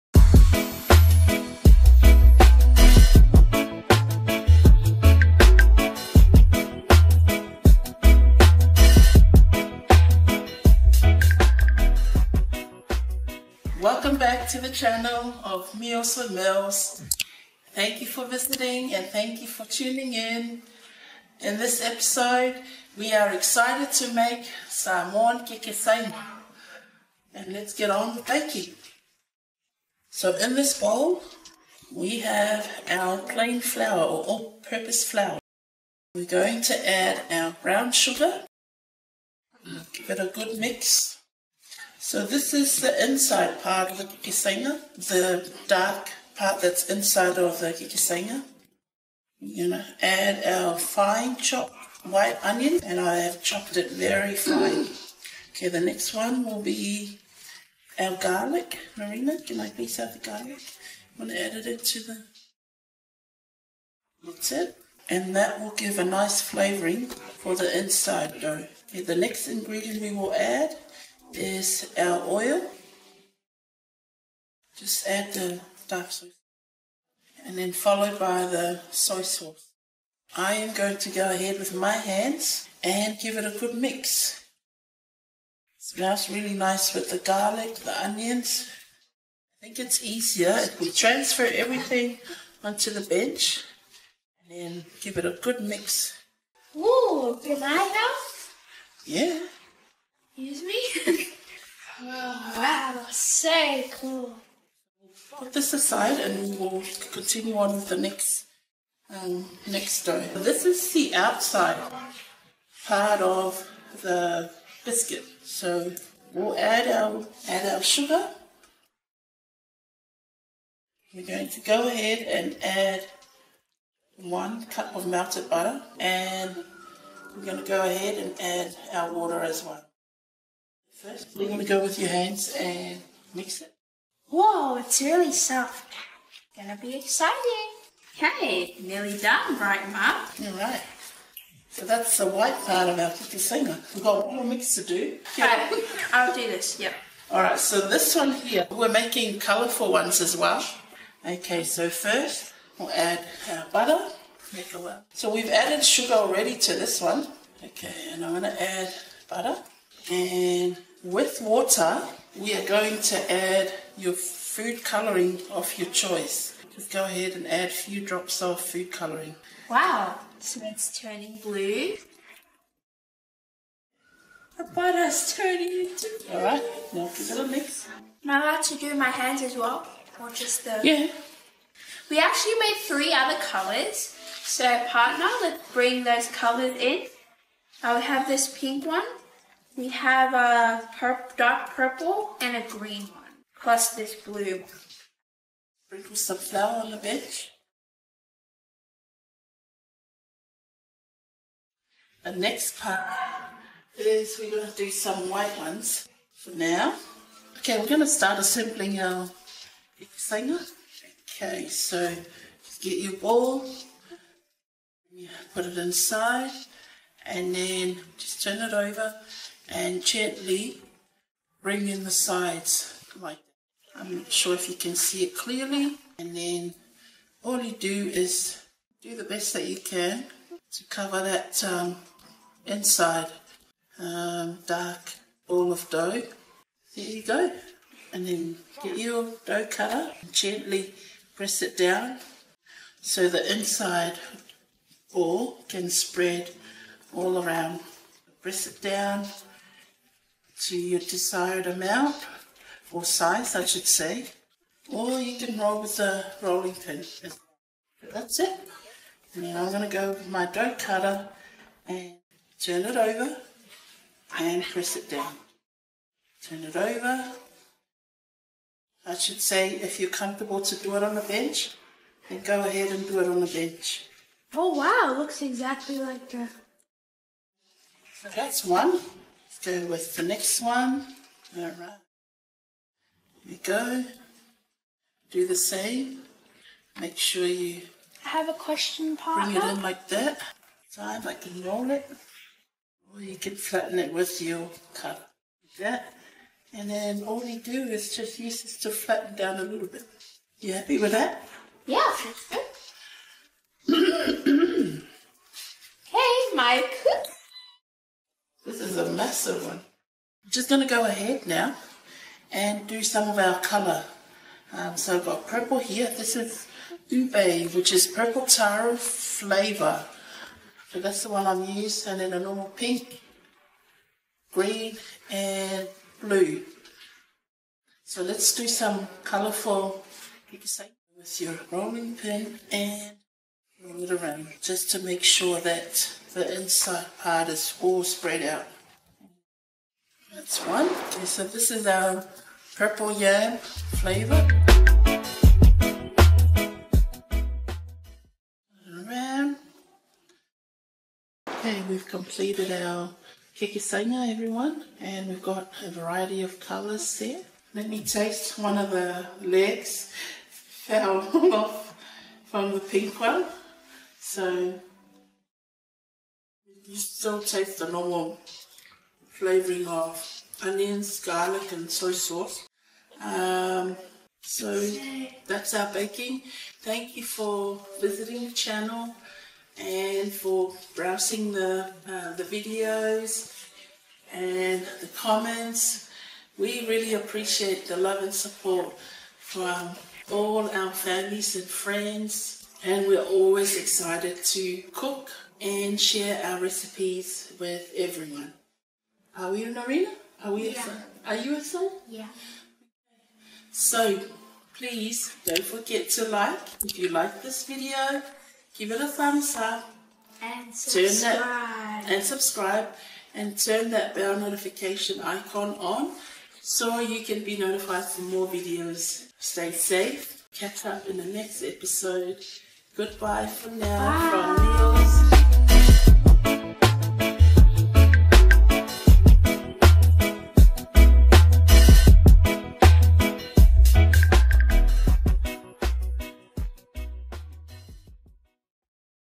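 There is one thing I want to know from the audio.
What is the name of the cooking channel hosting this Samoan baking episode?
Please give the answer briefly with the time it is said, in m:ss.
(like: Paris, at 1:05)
Meals with Milz, at 0:15.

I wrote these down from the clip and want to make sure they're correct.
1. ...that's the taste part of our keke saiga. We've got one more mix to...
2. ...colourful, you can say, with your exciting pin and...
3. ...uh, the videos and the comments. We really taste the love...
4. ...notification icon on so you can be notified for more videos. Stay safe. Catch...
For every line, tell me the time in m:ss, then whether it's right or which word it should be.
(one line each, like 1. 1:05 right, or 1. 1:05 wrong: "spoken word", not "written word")
1. 2:21 wrong: "white", not "taste"
2. 5:29 wrong: "rolling", not "exciting"
3. 6:22 wrong: "appreciate", not "taste"
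4. 6:54 right.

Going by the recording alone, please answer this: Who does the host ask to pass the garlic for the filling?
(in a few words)
Marina.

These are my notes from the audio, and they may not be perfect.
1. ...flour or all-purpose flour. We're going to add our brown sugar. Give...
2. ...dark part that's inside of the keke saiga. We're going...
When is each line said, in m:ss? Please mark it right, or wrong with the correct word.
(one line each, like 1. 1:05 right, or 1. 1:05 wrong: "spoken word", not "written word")
1. 0:33 right
2. 0:45 right.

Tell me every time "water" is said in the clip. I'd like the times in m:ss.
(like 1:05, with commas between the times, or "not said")
2:09, 2:41.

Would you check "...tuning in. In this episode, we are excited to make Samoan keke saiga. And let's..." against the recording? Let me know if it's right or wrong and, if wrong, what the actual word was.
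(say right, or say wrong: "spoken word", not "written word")
right.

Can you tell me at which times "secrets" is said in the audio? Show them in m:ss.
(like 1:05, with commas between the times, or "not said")
not said.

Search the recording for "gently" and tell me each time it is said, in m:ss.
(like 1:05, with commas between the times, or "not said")
3:40, 4:00.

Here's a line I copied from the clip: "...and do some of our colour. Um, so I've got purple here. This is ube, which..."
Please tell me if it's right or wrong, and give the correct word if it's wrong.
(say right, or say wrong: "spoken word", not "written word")
right.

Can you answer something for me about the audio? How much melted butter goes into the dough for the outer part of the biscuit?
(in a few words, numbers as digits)
one cup.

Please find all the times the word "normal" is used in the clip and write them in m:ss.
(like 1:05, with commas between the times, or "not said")
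5:22, 6:07.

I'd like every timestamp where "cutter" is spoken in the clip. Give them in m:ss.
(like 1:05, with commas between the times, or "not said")
3:59, 4:20.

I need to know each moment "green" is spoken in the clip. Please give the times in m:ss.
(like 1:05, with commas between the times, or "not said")
3:12, 5:24.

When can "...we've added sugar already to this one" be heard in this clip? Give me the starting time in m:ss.
2:35.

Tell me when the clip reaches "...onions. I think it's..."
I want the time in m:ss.
1:28.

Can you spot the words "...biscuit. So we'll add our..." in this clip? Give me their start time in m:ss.
1:54.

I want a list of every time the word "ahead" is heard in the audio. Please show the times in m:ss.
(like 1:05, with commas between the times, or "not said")
1:21, 2:01, 2:07, 2:47, 4:32, 5:11.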